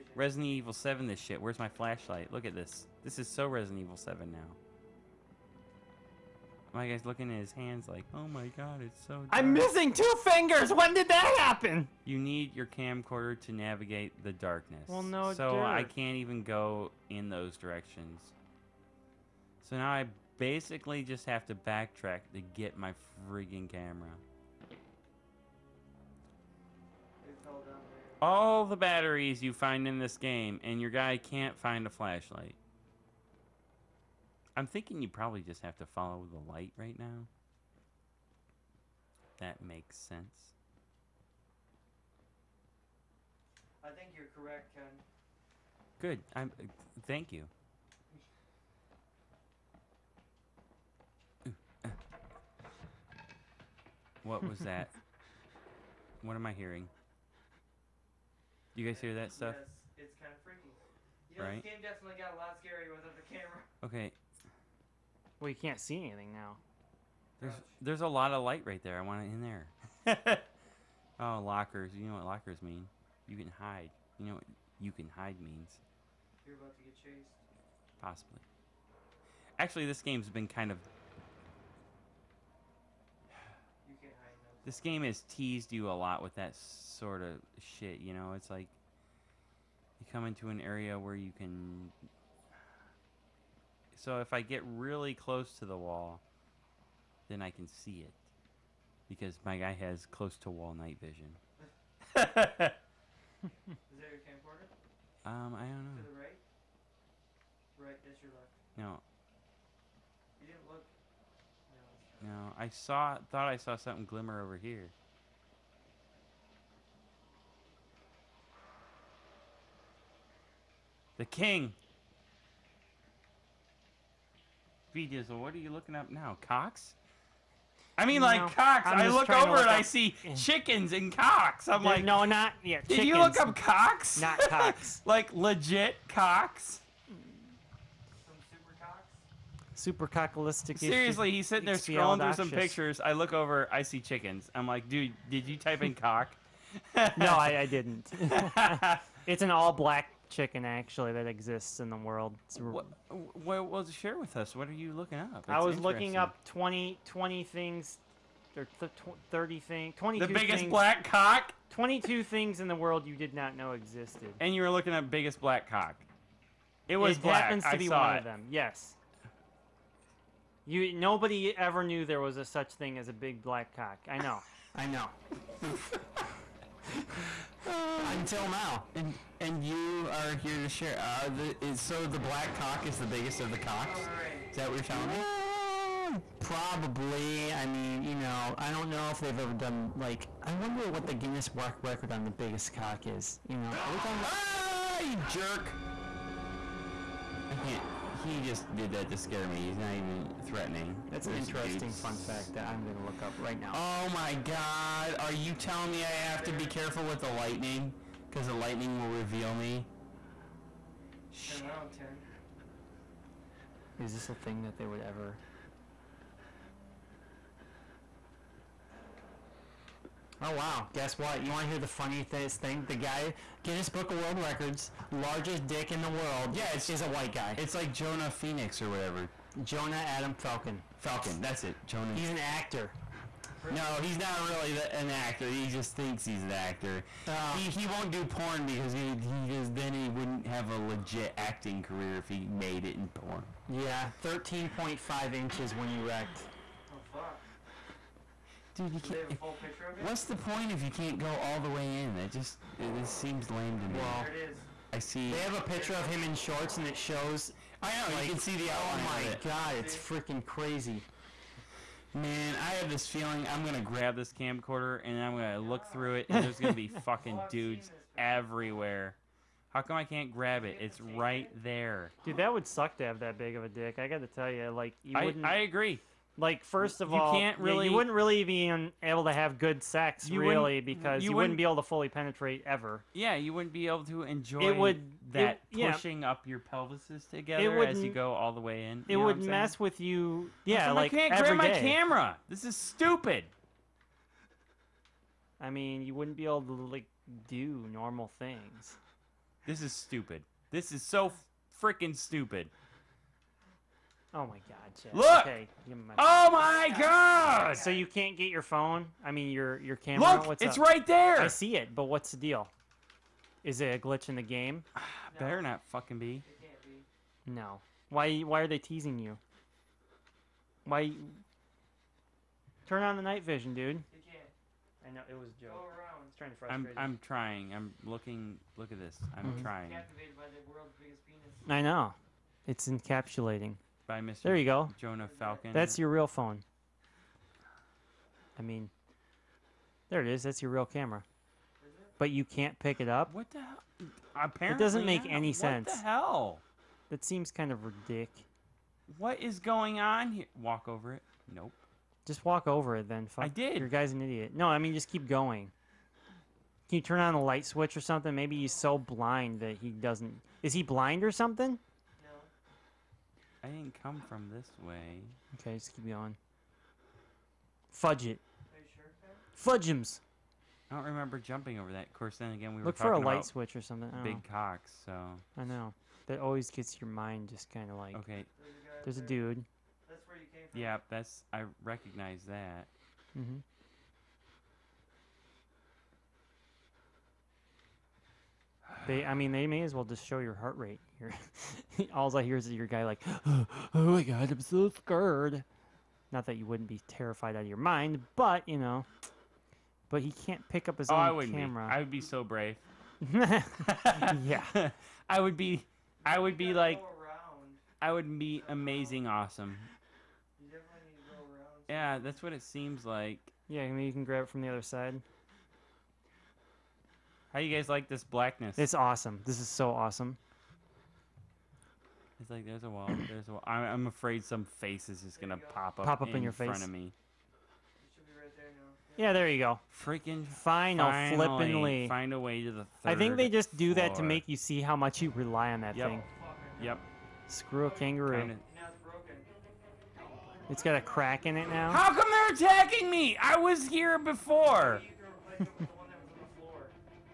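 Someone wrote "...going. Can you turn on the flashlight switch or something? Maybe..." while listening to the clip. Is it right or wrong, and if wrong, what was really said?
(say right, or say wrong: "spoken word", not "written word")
wrong: "light", not "flashlight".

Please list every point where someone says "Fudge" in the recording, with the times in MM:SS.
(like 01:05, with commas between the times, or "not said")
06:07.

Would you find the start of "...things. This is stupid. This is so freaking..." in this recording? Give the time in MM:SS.
04:58.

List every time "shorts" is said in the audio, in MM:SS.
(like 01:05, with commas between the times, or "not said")
04:16.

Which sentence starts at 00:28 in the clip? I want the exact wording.
All the batteries you find in this game, and your guy can't find a flashlight.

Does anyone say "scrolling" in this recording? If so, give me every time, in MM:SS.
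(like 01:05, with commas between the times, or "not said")
02:21.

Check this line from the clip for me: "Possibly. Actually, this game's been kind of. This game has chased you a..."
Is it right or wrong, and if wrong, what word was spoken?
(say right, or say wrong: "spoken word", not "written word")
wrong: "teased", not "chased".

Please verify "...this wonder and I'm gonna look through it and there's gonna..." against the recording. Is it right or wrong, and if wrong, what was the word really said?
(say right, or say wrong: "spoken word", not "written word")
wrong: "camcorder", not "wonder".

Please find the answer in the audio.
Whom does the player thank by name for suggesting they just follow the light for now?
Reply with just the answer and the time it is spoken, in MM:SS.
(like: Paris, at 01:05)
Ken, at 00:44.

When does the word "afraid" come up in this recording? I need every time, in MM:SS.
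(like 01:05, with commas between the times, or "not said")
07:04.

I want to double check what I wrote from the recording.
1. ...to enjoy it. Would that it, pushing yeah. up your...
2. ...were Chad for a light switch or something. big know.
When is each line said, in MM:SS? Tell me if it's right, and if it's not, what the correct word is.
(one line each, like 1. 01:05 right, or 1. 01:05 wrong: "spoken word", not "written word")
1. 04:44 right
2. 06:12 wrong: "Look", not "Chad".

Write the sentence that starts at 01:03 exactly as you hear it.
Okay, well, you can't see anything now.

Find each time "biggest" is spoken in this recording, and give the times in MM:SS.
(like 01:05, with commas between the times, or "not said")
02:40, 02:45, 03:03, 03:12.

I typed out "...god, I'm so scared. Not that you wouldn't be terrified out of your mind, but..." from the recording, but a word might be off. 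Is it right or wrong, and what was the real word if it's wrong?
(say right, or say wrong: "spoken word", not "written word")
right.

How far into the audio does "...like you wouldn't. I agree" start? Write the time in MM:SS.
04:34.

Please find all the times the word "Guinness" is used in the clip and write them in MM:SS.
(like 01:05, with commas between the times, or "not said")
03:11, 03:43.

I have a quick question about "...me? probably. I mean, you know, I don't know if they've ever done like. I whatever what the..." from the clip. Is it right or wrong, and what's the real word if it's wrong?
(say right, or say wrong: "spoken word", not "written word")
wrong: "wonder", not "whatever".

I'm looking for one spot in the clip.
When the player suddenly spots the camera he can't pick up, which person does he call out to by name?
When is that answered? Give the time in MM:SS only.
05:05.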